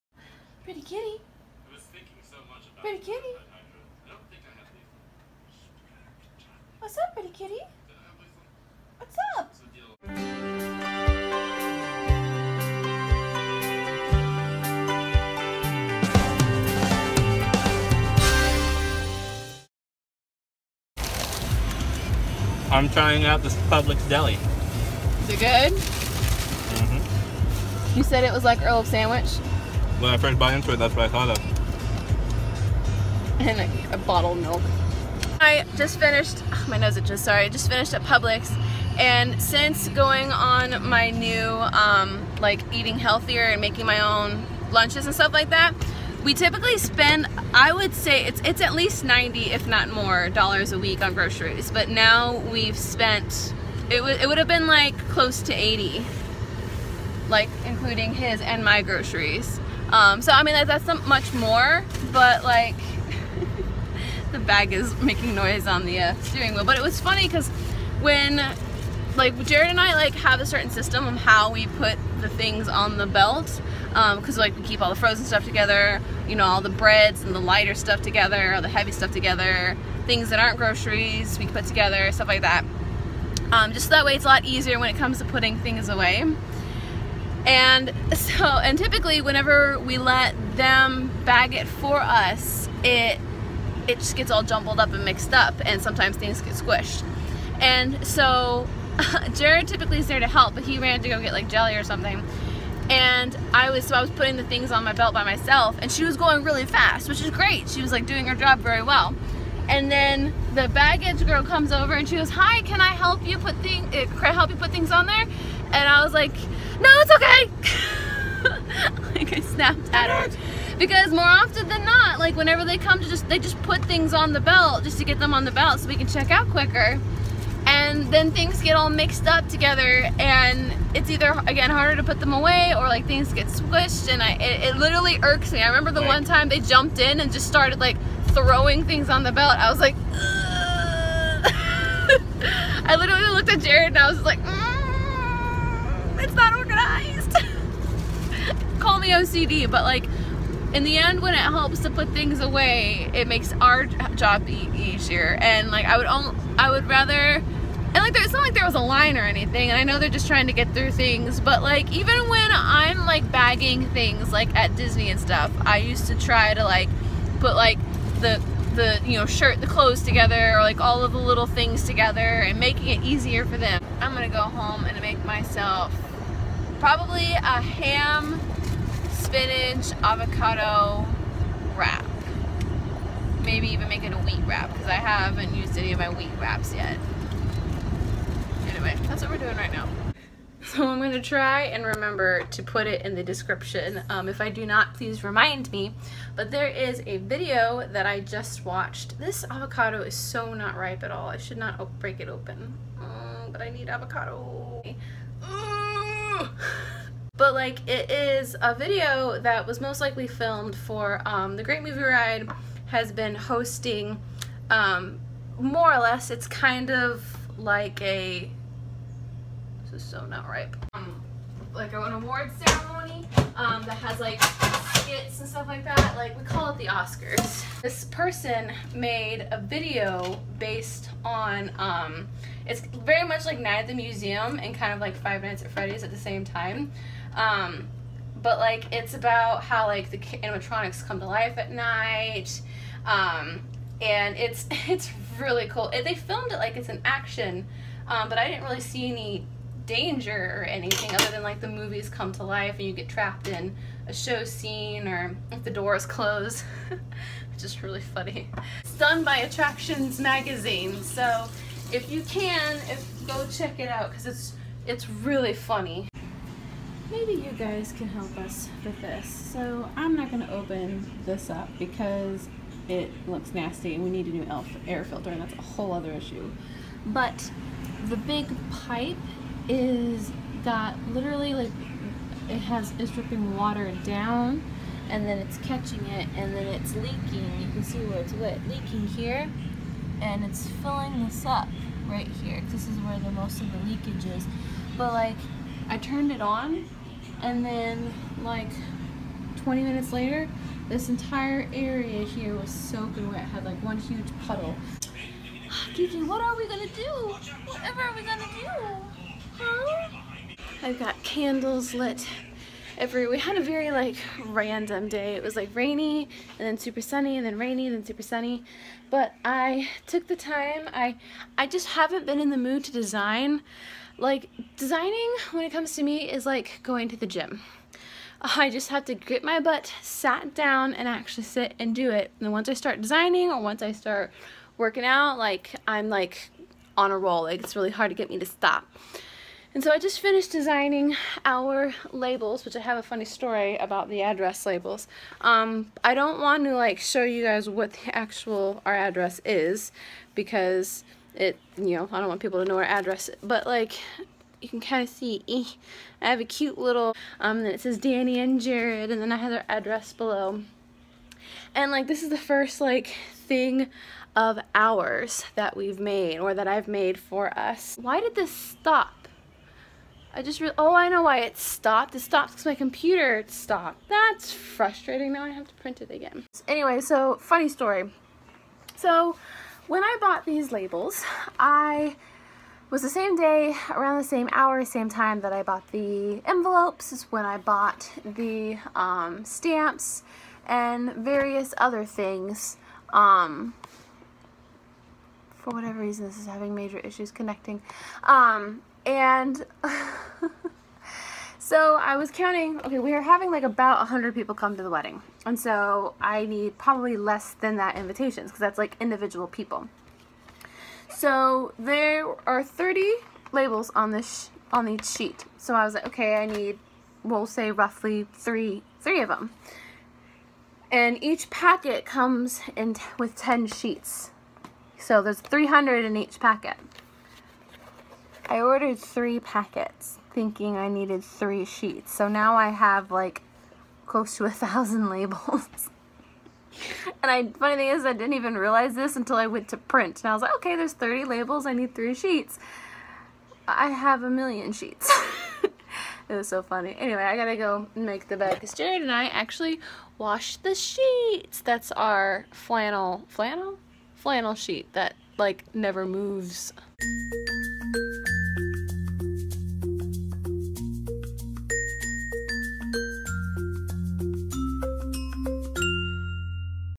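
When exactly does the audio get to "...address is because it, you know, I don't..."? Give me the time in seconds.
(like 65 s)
348 s.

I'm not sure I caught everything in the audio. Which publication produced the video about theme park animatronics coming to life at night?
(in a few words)
Attractions Magazine.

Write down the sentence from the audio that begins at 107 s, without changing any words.
She was like doing her job very well.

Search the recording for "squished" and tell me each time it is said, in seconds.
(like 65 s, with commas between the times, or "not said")
96 s, 133 s.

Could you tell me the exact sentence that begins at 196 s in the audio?
But there is a video that I just watched.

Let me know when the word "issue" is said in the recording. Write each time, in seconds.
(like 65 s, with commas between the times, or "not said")
276 s, 396 s.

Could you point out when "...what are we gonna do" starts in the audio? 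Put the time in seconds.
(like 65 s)
306 s.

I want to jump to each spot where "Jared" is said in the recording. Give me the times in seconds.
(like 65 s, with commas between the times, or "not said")
69 s, 99 s, 143 s, 358 s, 448 s.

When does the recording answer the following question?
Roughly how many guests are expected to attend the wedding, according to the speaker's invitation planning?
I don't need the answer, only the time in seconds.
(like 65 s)
403 s.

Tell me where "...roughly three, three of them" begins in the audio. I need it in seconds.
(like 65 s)
417 s.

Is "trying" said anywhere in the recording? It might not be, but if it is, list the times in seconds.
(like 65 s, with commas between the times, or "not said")
22 s, 160 s.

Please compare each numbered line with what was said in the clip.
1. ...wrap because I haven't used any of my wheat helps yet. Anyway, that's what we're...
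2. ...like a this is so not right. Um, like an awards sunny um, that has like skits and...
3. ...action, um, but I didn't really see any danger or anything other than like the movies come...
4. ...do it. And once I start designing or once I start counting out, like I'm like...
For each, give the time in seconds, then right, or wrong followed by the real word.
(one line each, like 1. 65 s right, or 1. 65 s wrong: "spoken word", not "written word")
1. 184 s wrong: "wraps", not "helps"
2. 217 s wrong: "ceremony", not "sunny"
3. 247 s right
4. 331 s wrong: "working", not "counting".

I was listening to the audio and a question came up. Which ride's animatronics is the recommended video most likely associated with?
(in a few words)
the Great Movie Ride.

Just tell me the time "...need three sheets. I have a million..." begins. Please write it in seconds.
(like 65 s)
441 s.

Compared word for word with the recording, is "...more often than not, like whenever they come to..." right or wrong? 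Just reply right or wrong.
right.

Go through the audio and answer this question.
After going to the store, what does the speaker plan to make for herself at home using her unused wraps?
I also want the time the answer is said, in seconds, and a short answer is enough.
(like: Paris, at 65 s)
ham, spinach, avocado wrap, at 177 s.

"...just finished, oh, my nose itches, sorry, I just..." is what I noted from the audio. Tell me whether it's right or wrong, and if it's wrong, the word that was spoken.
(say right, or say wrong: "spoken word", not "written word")
right.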